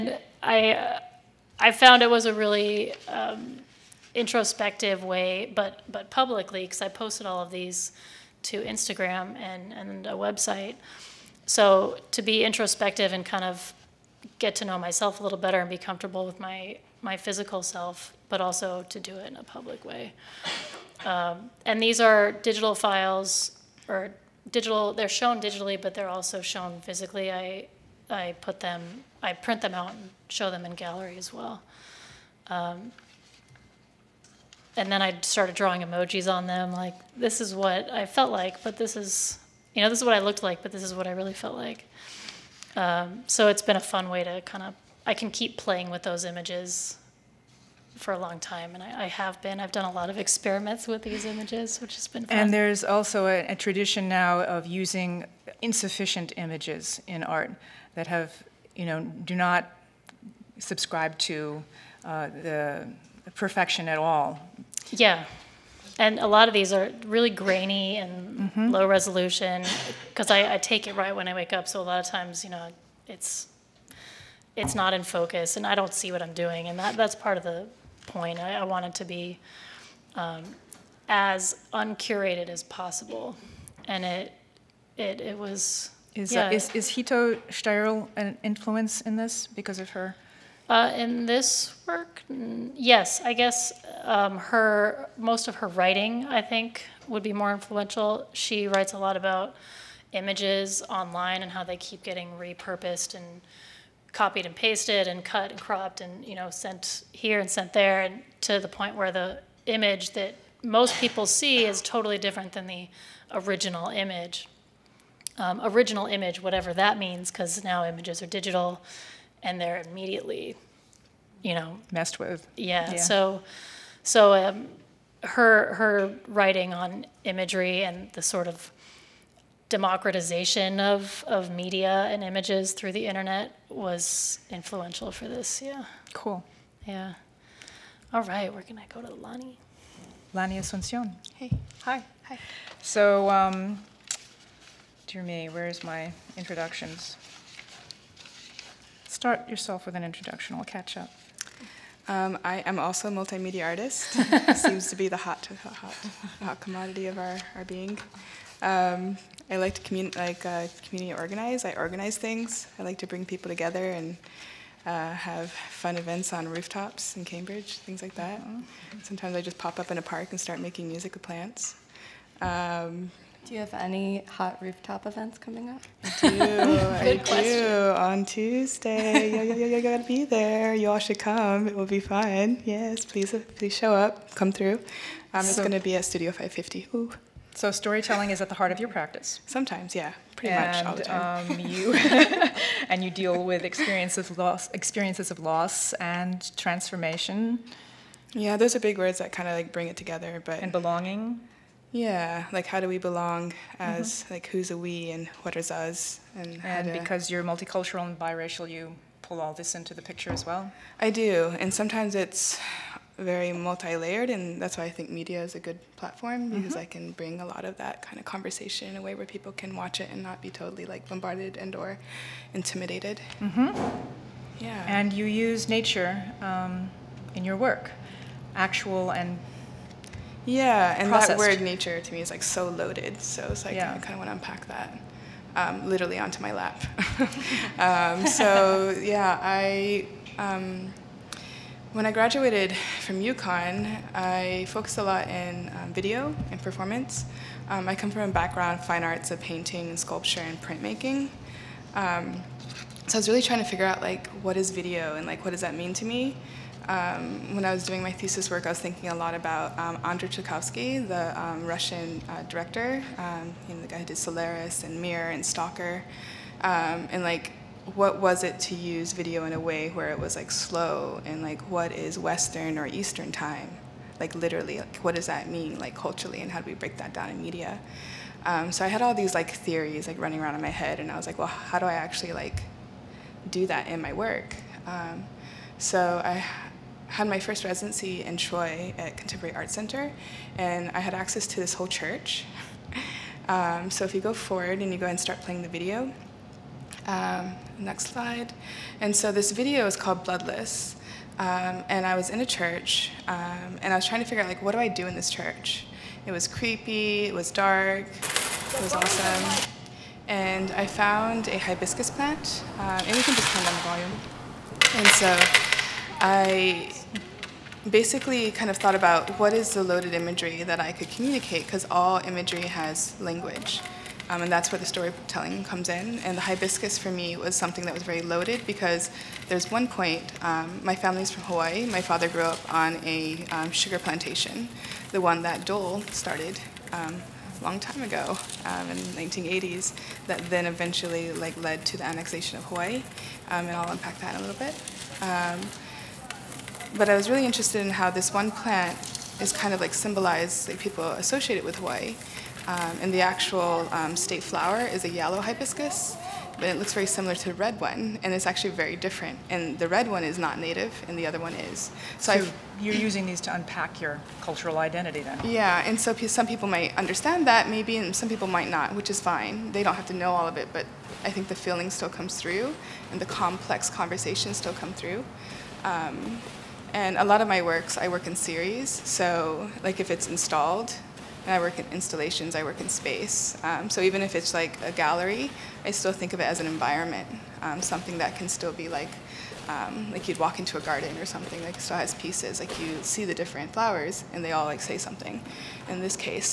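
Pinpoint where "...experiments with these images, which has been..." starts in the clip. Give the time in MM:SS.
00:50.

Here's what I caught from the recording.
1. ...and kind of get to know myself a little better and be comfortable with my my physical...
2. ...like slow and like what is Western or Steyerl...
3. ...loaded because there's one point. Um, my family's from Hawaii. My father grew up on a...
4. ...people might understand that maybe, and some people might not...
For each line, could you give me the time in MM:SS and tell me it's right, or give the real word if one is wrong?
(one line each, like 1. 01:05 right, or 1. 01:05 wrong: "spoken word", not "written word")
1. 00:13 right
2. 04:30 wrong: "Eastern", not "Steyerl"
3. 05:28 right
4. 06:06 right.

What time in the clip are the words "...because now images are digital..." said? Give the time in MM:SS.
01:57.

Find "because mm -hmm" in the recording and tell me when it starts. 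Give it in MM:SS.
03:36.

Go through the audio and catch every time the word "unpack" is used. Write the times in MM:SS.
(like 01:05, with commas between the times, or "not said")
03:54, 05:43, 06:03.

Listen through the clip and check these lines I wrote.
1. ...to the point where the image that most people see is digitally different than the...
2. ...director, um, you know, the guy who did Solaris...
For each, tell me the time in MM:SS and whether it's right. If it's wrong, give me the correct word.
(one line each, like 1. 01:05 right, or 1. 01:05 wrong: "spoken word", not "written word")
1. 01:48 wrong: "totally", not "digitally"
2. 04:22 right.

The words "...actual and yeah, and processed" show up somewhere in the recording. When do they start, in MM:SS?
03:48.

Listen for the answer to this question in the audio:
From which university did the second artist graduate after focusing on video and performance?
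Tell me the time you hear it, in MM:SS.
04:03.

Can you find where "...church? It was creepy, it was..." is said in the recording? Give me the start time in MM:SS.
05:05.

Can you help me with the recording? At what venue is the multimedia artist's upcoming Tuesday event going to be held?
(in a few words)
Studio 550.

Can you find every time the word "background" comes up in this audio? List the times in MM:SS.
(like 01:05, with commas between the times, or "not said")
04:08.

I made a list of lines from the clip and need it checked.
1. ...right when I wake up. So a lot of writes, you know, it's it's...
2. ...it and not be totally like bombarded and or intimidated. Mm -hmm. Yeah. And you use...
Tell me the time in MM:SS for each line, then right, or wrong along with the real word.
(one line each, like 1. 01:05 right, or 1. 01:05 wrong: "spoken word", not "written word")
1. 01:10 wrong: "times", not "writes"
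2. 03:40 right.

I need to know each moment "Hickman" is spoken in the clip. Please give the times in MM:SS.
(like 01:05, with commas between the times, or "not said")
not said.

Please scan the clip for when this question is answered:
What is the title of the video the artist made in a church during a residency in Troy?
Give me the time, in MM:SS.
05:00.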